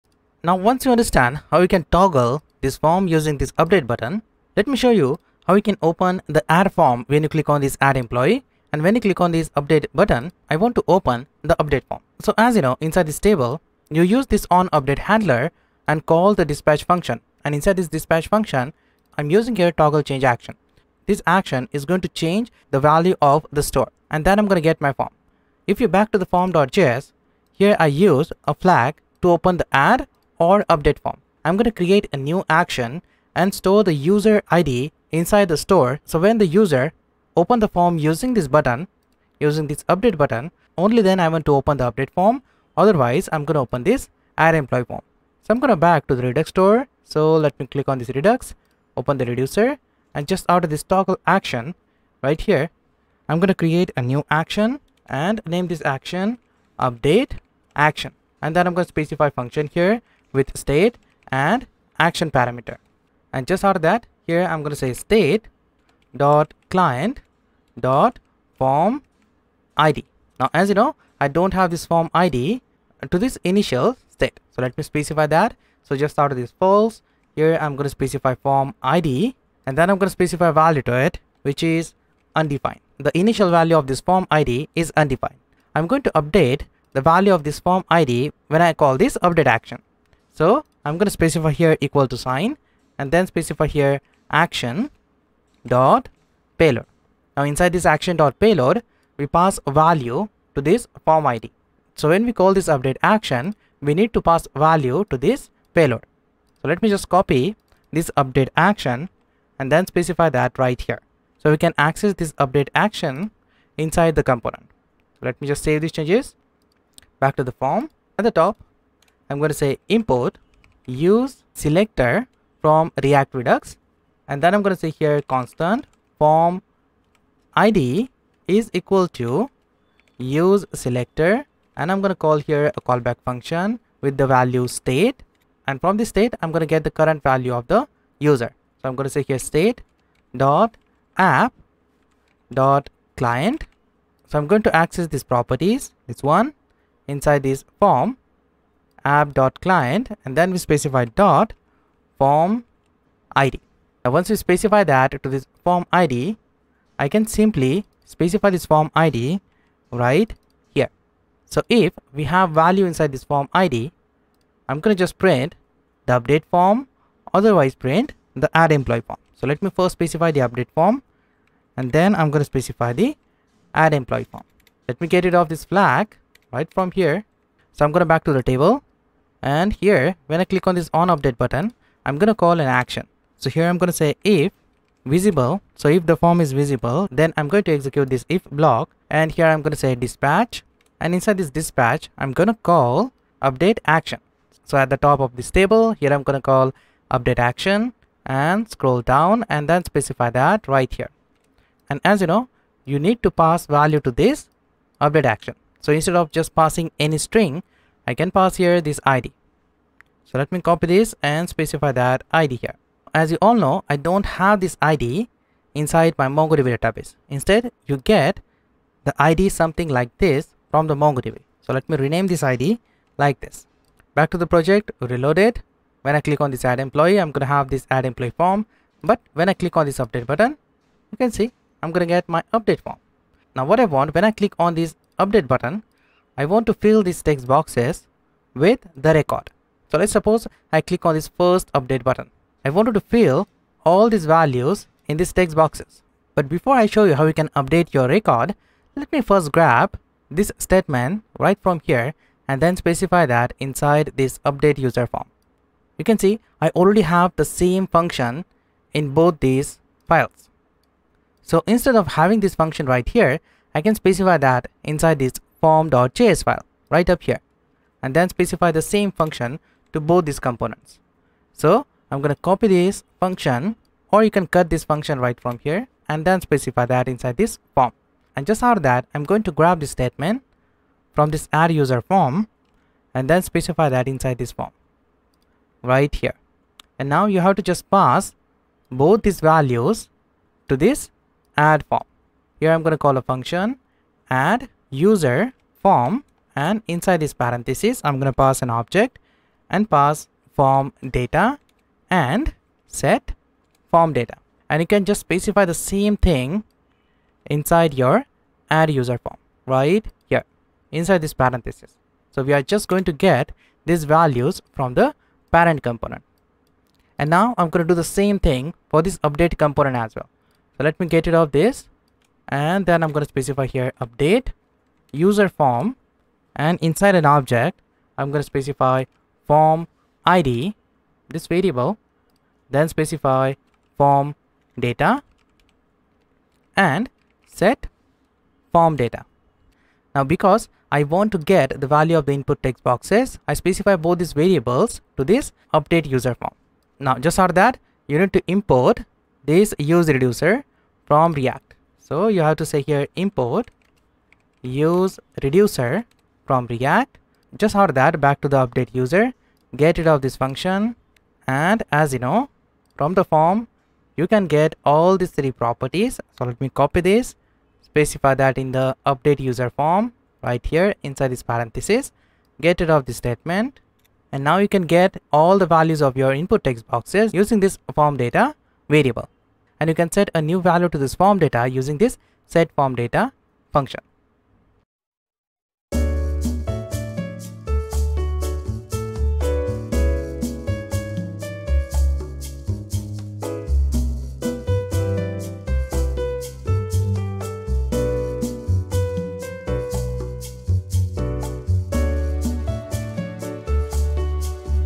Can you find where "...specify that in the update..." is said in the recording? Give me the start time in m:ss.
6:07.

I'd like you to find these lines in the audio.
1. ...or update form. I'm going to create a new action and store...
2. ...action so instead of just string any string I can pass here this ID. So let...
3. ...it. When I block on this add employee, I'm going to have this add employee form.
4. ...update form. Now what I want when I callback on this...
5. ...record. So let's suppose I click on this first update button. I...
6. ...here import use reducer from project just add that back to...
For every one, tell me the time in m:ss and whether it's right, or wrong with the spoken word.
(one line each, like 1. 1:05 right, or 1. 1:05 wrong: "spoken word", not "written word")
1. 0:30 right
2. 3:25 wrong: "passing", not "string"
3. 3:45 wrong: "click", not "block"
4. 3:52 wrong: "click", not "callback"
5. 3:59 right
6. 5:52 wrong: "react", not "project".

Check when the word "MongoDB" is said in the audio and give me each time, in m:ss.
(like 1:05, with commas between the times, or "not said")
3:36, 3:40.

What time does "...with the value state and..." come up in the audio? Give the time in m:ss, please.
2:14.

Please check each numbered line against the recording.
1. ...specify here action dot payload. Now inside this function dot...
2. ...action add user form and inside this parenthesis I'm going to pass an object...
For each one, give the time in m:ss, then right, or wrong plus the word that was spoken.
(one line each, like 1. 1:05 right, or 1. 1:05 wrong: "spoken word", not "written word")
1. 1:33 wrong: "action", not "function"
2. 4:53 wrong: "function", not "action".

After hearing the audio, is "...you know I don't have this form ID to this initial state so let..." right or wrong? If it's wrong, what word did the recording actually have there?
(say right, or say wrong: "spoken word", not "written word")
right.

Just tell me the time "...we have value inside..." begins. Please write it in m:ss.
2:42.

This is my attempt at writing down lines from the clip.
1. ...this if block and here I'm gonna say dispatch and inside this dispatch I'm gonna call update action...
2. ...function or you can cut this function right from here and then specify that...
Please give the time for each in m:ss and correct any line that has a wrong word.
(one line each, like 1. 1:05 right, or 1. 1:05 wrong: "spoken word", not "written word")
1. 3:08 right
2. 4:33 right.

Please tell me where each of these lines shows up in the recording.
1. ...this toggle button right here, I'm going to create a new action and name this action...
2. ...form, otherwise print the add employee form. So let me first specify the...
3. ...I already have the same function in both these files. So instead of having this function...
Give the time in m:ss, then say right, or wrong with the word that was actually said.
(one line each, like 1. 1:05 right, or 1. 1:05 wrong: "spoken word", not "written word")
1. 0:50 wrong: "action", not "button"
2. 2:46 right
3. 4:16 right.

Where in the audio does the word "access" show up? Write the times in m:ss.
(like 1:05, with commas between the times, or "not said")
1:51, 2:24.